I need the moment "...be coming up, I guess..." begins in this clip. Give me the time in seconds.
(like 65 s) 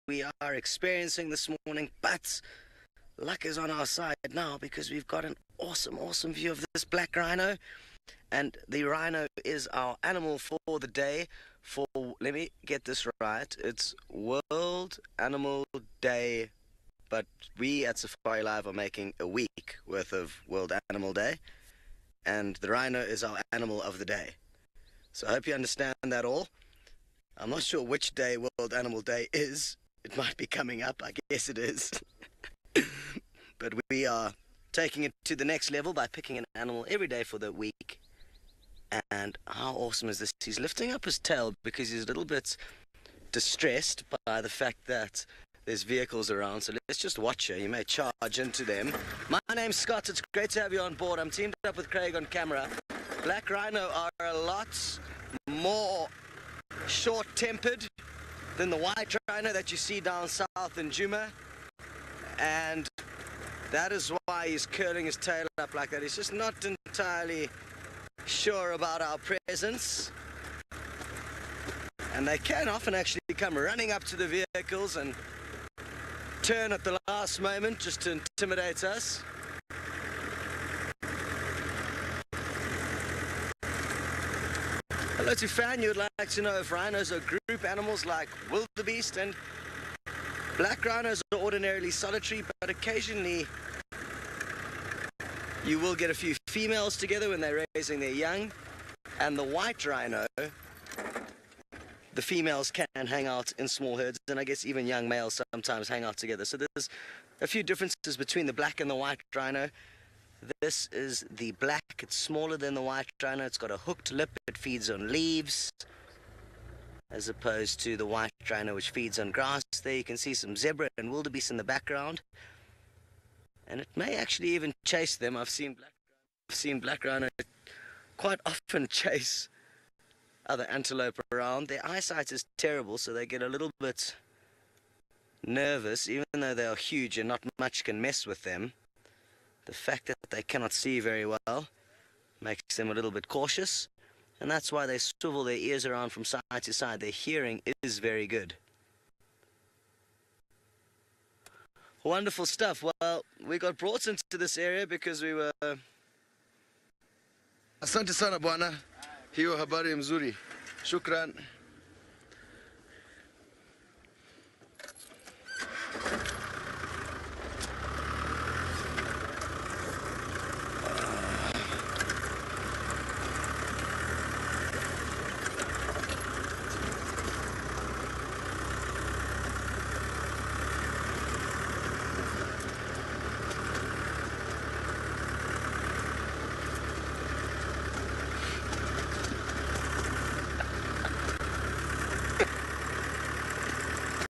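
30 s.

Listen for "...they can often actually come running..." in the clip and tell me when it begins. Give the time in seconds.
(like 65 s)
72 s.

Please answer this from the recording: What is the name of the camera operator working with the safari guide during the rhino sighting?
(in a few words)
Craig.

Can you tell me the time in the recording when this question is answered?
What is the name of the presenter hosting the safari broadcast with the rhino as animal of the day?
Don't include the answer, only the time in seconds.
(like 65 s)
49 s.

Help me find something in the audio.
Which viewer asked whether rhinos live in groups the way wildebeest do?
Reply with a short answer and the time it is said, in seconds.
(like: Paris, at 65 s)
Fan, at 85 s.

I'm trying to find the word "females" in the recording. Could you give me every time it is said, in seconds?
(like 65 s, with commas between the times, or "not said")
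96 s, 102 s.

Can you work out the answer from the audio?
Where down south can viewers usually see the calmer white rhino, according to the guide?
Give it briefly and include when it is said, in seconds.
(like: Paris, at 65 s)
Djuma, at 60 s.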